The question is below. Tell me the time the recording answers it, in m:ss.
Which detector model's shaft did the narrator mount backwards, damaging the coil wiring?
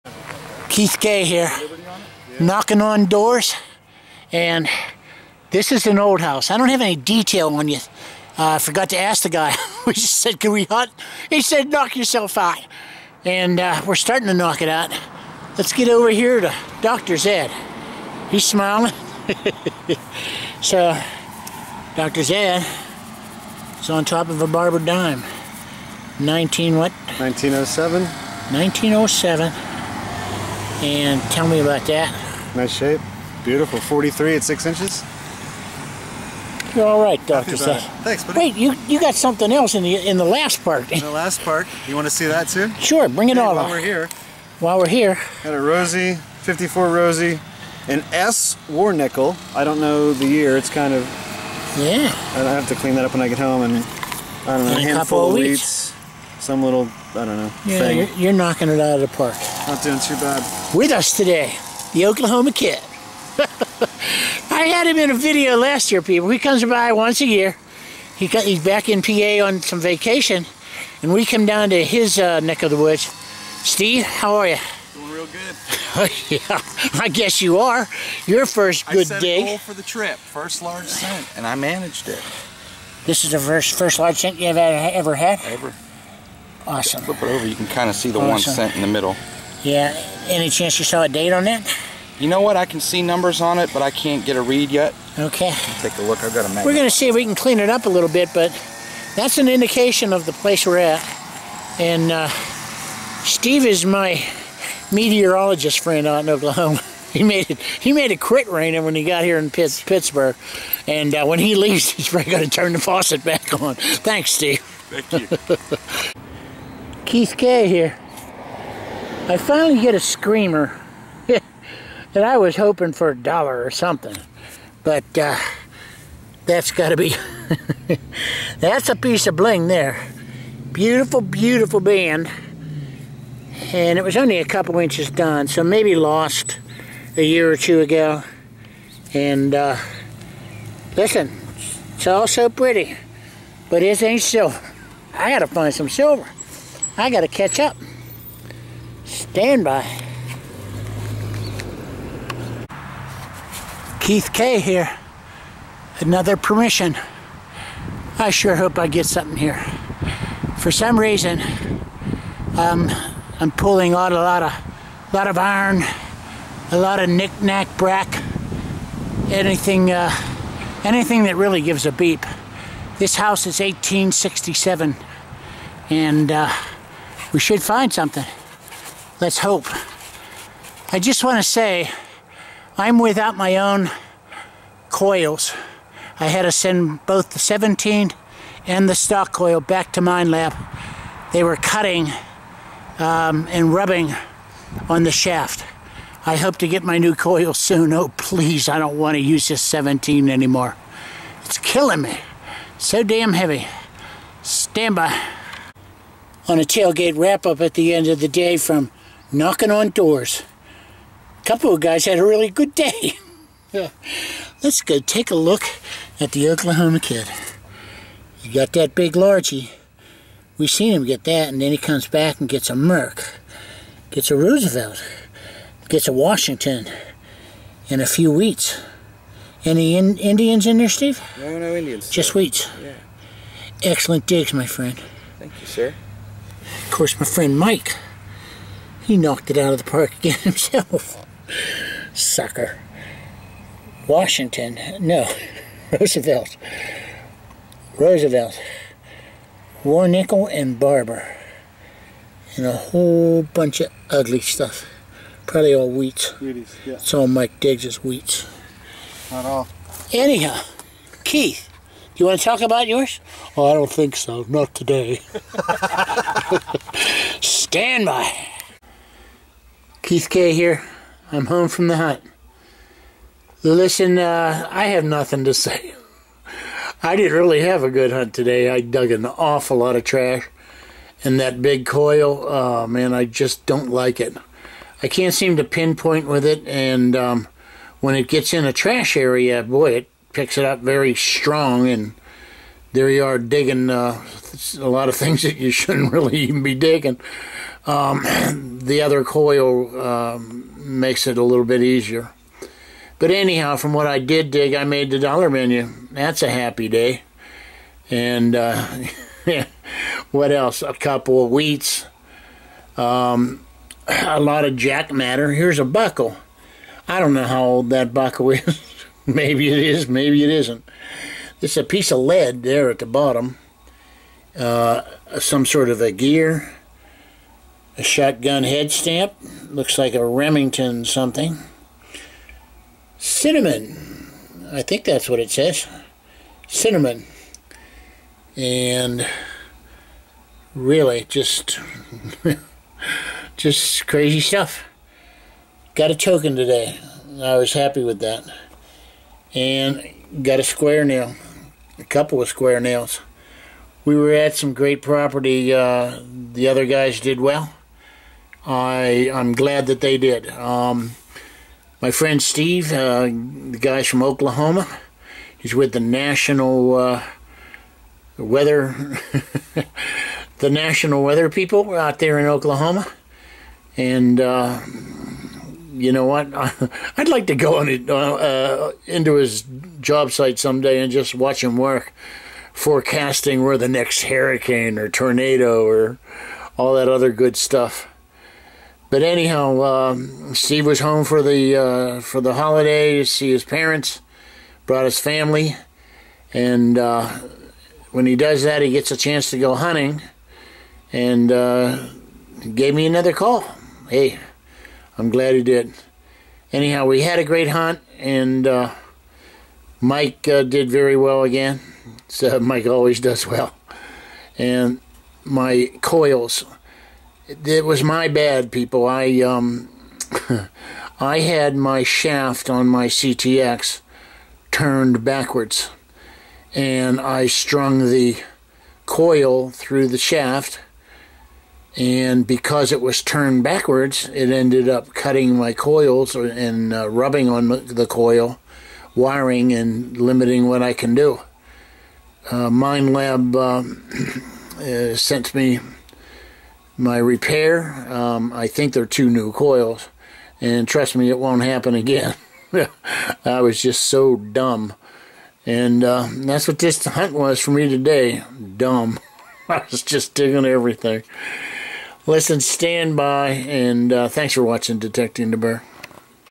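7:03.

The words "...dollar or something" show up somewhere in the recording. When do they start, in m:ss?
2:03.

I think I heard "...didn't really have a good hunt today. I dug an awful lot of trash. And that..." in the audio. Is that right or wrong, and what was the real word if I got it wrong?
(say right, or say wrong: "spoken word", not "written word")
right.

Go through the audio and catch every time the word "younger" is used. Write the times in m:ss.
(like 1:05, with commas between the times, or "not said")
not said.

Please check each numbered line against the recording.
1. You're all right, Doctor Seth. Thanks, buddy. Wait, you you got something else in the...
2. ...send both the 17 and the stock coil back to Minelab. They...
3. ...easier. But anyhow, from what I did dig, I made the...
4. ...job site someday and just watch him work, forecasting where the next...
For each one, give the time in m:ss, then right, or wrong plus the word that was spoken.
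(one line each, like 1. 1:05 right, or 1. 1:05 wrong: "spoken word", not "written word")
1. 0:36 right
2. 3:06 right
3. 5:01 right
4. 6:20 right.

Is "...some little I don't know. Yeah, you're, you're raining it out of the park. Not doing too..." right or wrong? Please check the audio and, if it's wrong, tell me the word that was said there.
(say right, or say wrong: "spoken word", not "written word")
wrong: "knocking", not "raining".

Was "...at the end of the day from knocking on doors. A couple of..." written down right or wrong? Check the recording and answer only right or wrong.
right.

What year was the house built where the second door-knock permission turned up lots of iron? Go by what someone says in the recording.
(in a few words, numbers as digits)
1867.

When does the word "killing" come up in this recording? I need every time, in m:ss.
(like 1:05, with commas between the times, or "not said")
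3:21.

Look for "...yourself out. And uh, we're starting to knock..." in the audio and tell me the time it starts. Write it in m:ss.
0:11.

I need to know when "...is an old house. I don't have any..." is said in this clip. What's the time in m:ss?
0:05.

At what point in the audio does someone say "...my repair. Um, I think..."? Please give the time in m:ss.
7:26.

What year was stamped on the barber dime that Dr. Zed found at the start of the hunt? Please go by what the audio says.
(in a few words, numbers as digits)
1907.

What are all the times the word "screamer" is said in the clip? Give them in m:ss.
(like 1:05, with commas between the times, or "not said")
1:59.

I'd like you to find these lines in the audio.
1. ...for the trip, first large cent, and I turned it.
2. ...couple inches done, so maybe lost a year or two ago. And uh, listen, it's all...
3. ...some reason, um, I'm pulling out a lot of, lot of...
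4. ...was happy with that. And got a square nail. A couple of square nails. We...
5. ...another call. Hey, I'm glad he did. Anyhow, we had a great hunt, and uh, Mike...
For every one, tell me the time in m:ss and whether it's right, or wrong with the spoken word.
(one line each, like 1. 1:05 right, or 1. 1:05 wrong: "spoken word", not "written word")
1. 1:19 wrong: "managed", not "turned"
2. 2:14 right
3. 2:40 right
4. 5:47 right
5. 6:43 right.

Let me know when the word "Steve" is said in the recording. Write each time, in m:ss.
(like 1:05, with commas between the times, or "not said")
1:13, 1:43, 1:54, 3:50, 6:02, 6:30.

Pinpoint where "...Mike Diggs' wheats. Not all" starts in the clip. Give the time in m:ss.
4:17.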